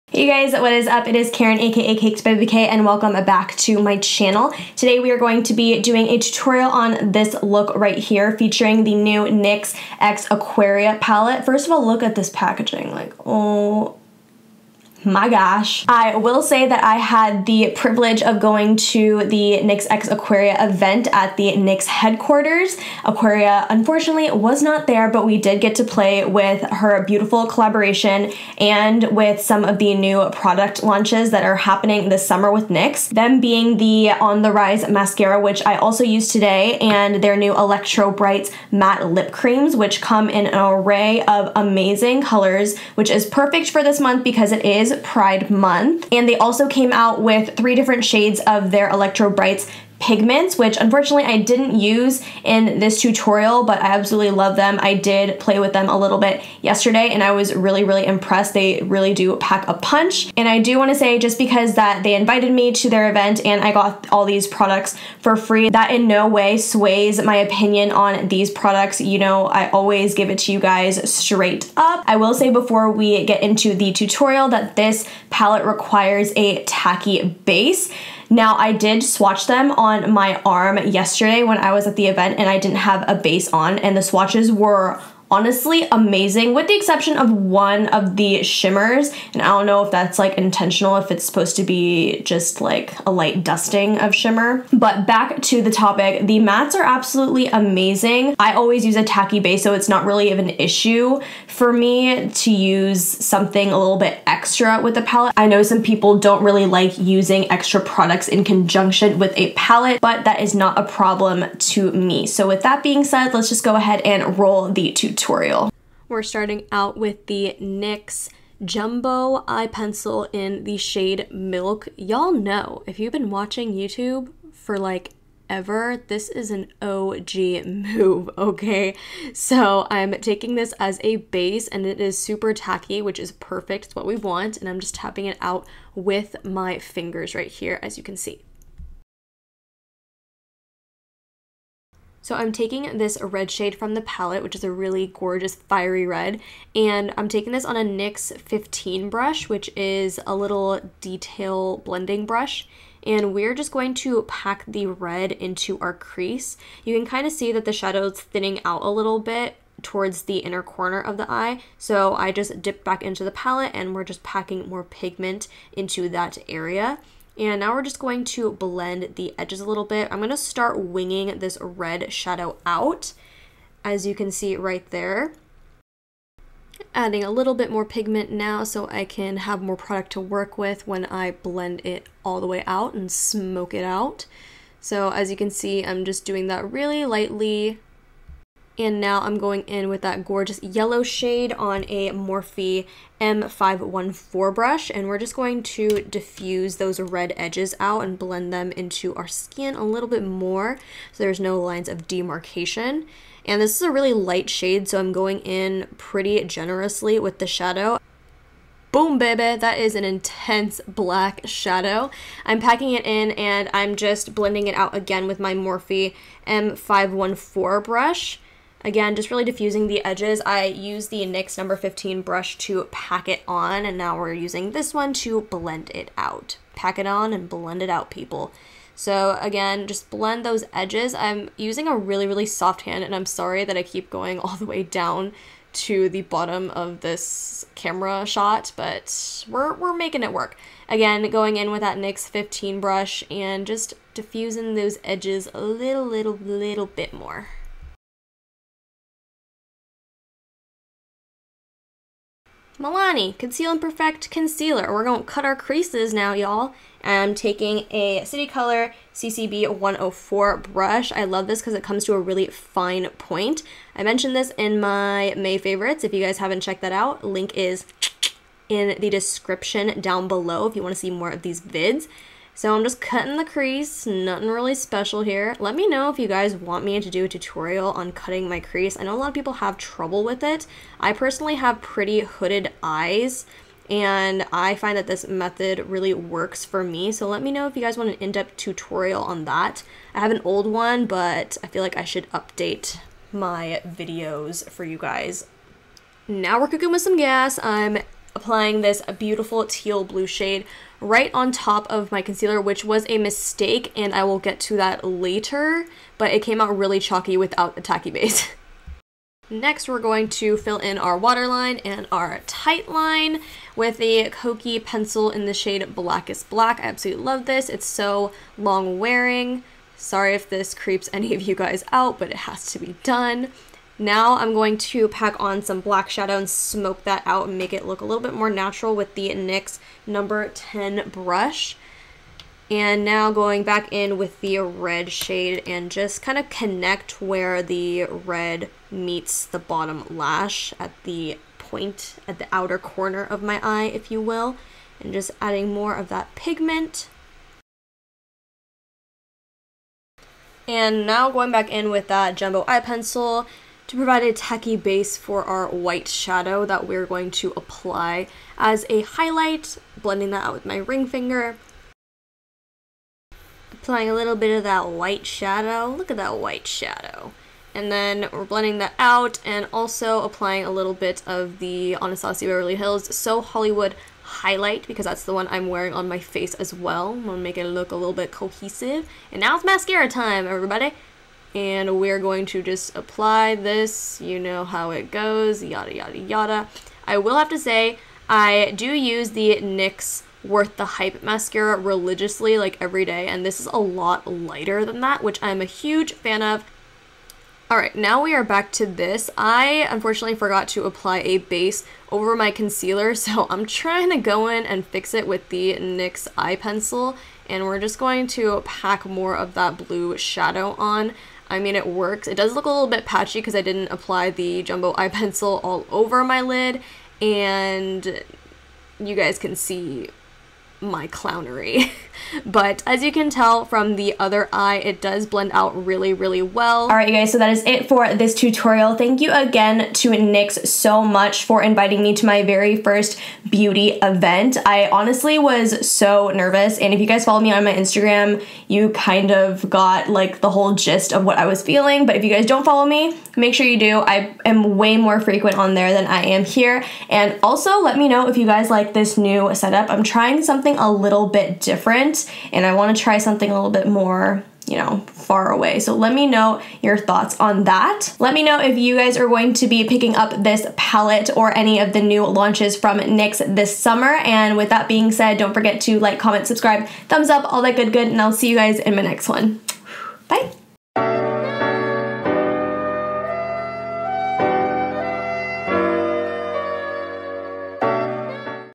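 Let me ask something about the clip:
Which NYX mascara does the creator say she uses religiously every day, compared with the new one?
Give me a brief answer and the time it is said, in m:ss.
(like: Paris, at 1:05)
Worth the Hype, at 6:30.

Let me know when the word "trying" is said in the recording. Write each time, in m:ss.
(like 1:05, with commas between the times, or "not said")
6:43, 7:30.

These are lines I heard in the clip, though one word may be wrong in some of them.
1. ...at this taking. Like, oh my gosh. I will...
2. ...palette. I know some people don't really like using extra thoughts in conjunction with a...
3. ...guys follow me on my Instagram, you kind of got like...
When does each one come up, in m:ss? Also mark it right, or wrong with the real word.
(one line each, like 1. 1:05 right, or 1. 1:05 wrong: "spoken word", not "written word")
1. 0:12 wrong: "packaging", not "taking"
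2. 1:45 wrong: "products", not "thoughts"
3. 7:17 right.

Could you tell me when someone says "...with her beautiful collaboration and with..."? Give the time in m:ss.
0:26.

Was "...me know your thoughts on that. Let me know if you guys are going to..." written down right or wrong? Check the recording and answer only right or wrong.
right.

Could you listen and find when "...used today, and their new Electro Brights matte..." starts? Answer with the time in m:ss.
0:36.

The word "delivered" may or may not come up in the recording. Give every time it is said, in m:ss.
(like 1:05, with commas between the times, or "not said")
not said.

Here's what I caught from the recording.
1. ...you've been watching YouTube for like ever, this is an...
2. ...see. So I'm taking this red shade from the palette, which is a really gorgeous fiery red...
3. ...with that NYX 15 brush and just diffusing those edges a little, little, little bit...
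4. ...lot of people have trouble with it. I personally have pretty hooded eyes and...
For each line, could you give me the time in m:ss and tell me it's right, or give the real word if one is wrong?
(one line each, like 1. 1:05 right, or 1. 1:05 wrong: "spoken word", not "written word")
1. 2:02 right
2. 2:18 right
3. 4:01 right
4. 4:39 right.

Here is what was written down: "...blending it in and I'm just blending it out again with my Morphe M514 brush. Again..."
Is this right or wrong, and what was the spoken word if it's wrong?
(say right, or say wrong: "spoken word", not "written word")
wrong: "packing", not "blending".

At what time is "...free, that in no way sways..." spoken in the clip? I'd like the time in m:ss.
1:05.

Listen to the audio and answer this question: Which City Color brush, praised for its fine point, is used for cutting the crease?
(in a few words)
CCB 104.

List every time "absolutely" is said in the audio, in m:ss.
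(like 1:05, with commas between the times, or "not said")
0:53, 1:36, 5:16.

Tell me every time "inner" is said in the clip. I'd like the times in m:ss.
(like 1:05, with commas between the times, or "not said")
2:40.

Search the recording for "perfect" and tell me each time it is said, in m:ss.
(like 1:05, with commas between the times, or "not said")
0:43, 2:13, 4:13.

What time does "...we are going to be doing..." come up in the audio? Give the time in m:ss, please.
0:04.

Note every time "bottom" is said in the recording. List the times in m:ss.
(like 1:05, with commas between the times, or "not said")
3:56, 5:39.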